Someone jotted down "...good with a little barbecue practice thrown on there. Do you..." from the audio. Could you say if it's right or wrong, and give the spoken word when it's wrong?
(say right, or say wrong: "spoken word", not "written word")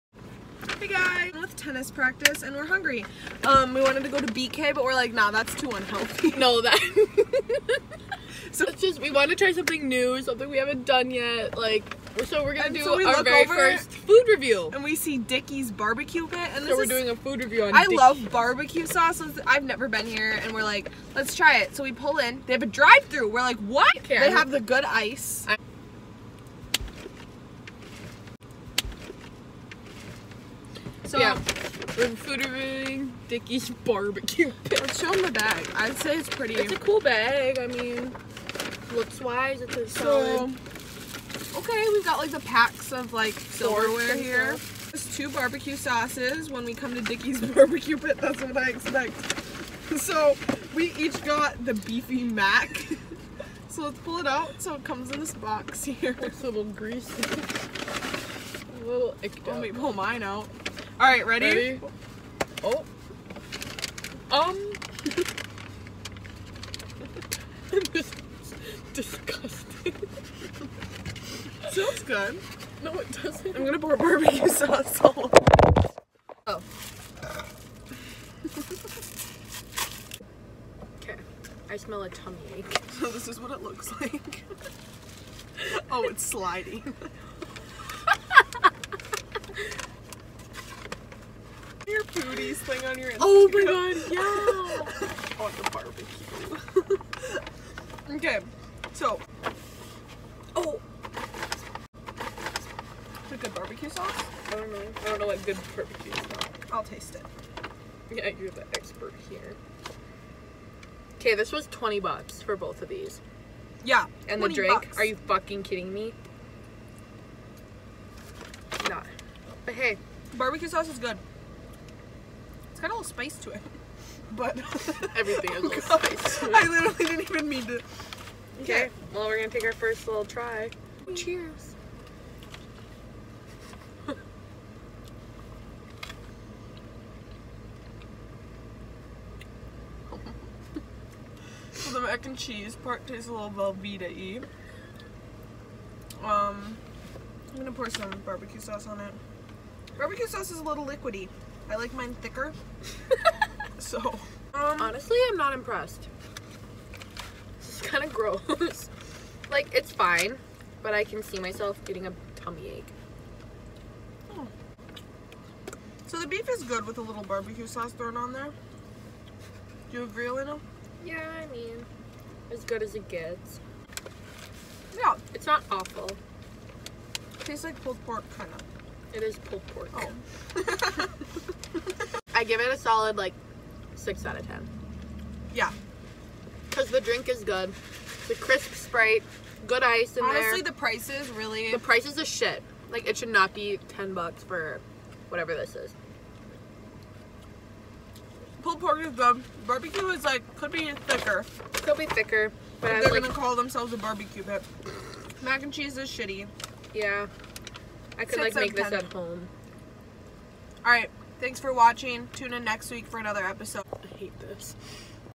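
wrong: "sauce", not "practice".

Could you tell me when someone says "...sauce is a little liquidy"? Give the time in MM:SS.
02:30.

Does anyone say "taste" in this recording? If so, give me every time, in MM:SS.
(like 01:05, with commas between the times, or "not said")
01:46, 02:23, 02:57.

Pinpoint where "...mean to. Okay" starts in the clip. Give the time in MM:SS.
02:07.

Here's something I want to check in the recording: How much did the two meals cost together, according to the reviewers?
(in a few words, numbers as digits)
$20.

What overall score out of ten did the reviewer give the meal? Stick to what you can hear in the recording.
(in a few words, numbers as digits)
6.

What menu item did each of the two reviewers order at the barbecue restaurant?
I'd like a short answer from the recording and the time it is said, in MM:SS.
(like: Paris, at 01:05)
Beefy mac, at 00:51.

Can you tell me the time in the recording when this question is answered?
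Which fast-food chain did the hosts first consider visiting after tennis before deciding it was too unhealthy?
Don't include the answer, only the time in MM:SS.
00:04.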